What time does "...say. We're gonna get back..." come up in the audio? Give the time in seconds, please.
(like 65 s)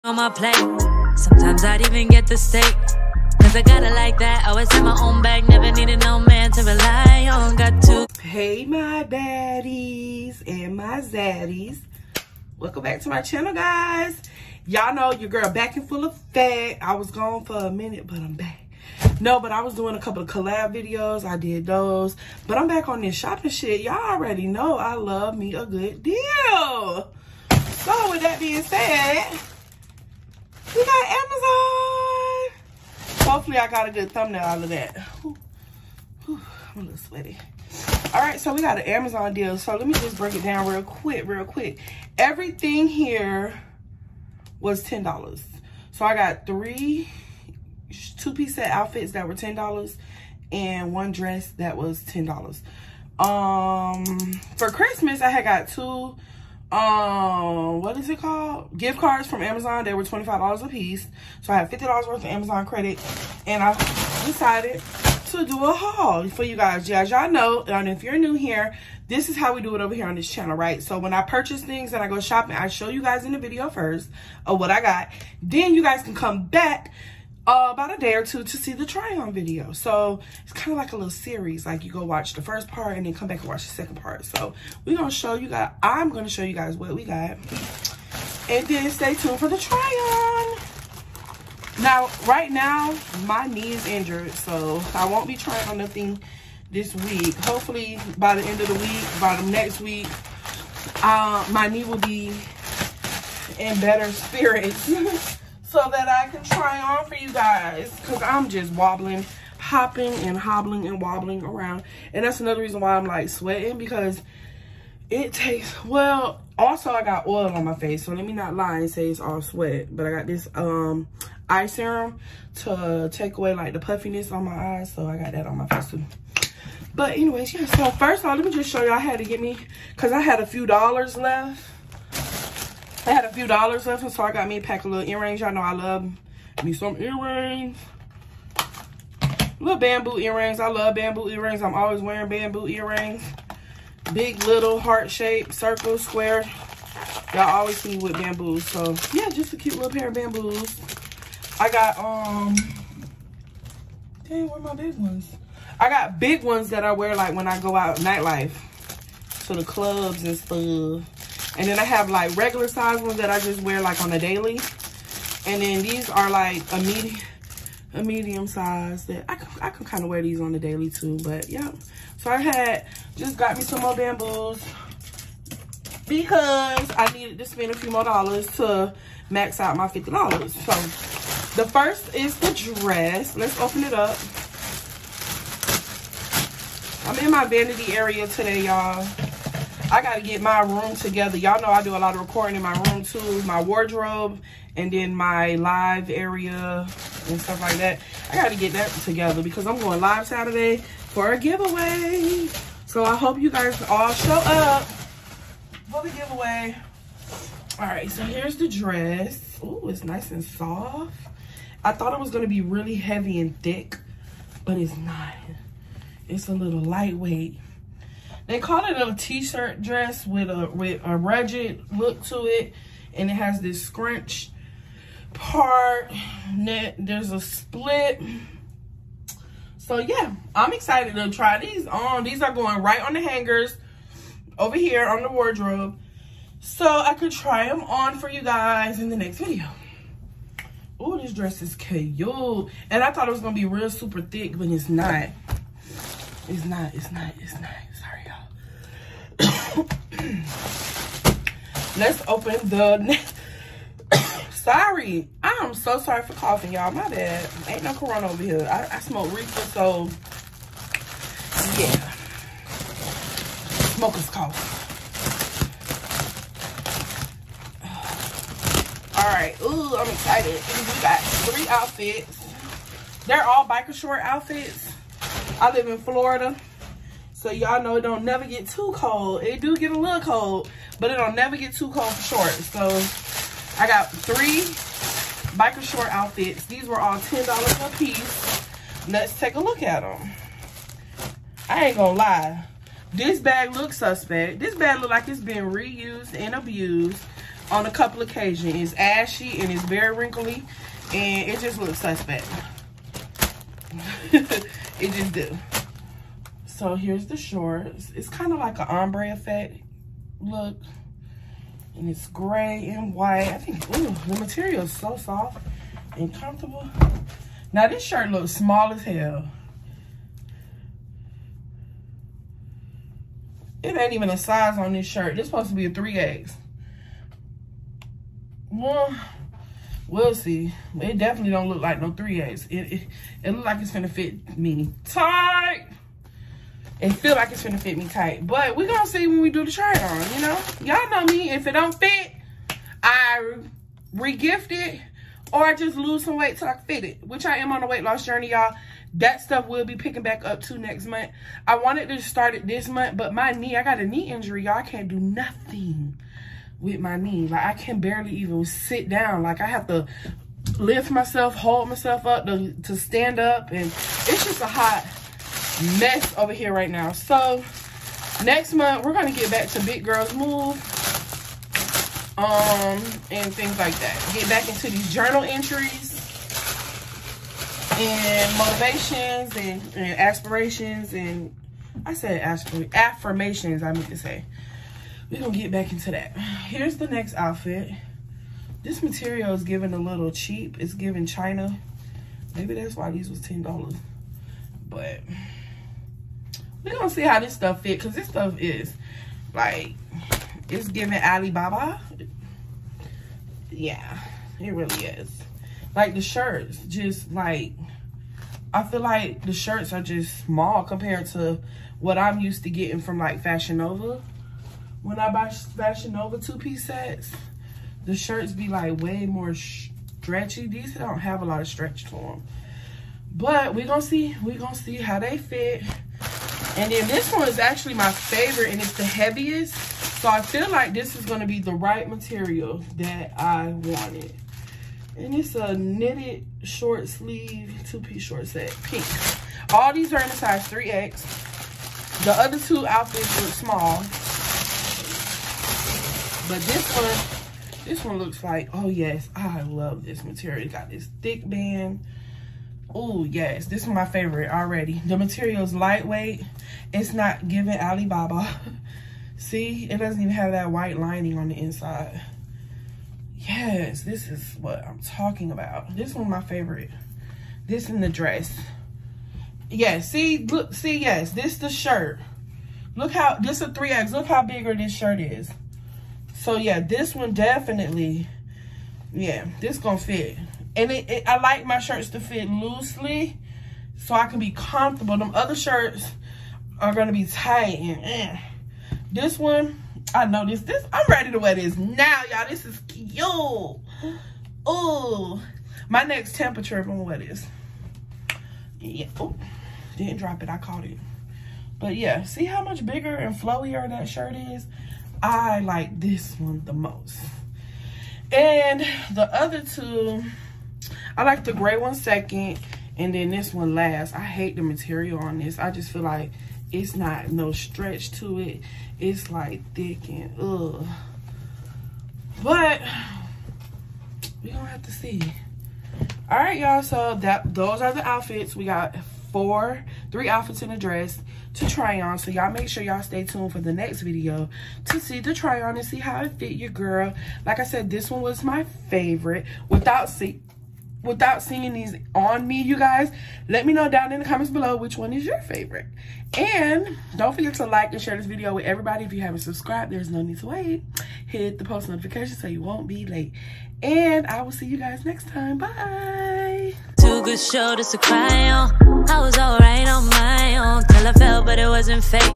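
384 s.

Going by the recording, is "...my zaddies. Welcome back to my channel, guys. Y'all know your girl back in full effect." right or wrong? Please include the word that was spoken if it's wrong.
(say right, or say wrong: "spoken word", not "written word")
right.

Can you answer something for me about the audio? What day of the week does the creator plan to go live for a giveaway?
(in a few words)
Saturday.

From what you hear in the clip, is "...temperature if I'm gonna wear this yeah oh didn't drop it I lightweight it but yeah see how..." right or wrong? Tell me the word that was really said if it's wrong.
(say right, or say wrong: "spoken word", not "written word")
wrong: "caught", not "lightweight".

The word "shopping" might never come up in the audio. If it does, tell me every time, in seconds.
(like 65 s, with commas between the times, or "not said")
23 s, 72 s.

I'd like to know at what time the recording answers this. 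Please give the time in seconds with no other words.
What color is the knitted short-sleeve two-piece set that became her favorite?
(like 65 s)
438 s.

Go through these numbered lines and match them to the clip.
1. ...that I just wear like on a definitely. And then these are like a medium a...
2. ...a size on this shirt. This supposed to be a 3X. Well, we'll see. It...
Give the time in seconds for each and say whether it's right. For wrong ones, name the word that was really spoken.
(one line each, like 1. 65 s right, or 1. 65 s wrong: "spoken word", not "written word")
1. 163 s wrong: "daily", not "definitely"
2. 324 s right.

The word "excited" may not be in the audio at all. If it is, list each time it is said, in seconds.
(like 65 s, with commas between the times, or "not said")
230 s, 270 s.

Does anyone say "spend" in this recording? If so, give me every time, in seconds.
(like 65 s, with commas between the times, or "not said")
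177 s.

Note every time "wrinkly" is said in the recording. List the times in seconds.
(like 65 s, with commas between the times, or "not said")
300 s.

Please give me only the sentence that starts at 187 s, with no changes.
I'm in my vanity area today, y'all.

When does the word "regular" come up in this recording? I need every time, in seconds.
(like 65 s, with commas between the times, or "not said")
162 s.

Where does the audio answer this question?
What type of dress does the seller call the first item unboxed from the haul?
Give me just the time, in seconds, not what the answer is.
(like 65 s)
219 s.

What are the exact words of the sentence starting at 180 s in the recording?
So the first is the dress.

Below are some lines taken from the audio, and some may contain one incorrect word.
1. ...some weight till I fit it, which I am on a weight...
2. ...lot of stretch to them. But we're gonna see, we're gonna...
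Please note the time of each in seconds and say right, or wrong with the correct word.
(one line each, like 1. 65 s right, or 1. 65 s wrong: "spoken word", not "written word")
1. 346 s right
2. 421 s right.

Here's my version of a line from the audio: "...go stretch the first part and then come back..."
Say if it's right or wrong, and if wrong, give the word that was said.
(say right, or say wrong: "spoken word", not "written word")
wrong: "watch", not "stretch".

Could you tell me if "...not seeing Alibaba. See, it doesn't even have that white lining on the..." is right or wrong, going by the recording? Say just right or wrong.
wrong.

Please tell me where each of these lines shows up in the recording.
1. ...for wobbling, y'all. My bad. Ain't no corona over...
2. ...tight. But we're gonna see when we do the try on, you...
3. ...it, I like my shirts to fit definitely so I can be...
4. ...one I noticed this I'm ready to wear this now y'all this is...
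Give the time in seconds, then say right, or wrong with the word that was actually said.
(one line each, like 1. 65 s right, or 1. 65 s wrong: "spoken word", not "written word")
1. 256 s wrong: "coughing", not "wobbling"
2. 338 s right
3. 481 s wrong: "loosely", not "definitely"
4. 489 s right.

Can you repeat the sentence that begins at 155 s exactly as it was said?
I got big ones that I wear, like, when I go out nightlife.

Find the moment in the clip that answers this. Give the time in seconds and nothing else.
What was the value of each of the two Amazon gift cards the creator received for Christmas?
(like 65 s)
60 s.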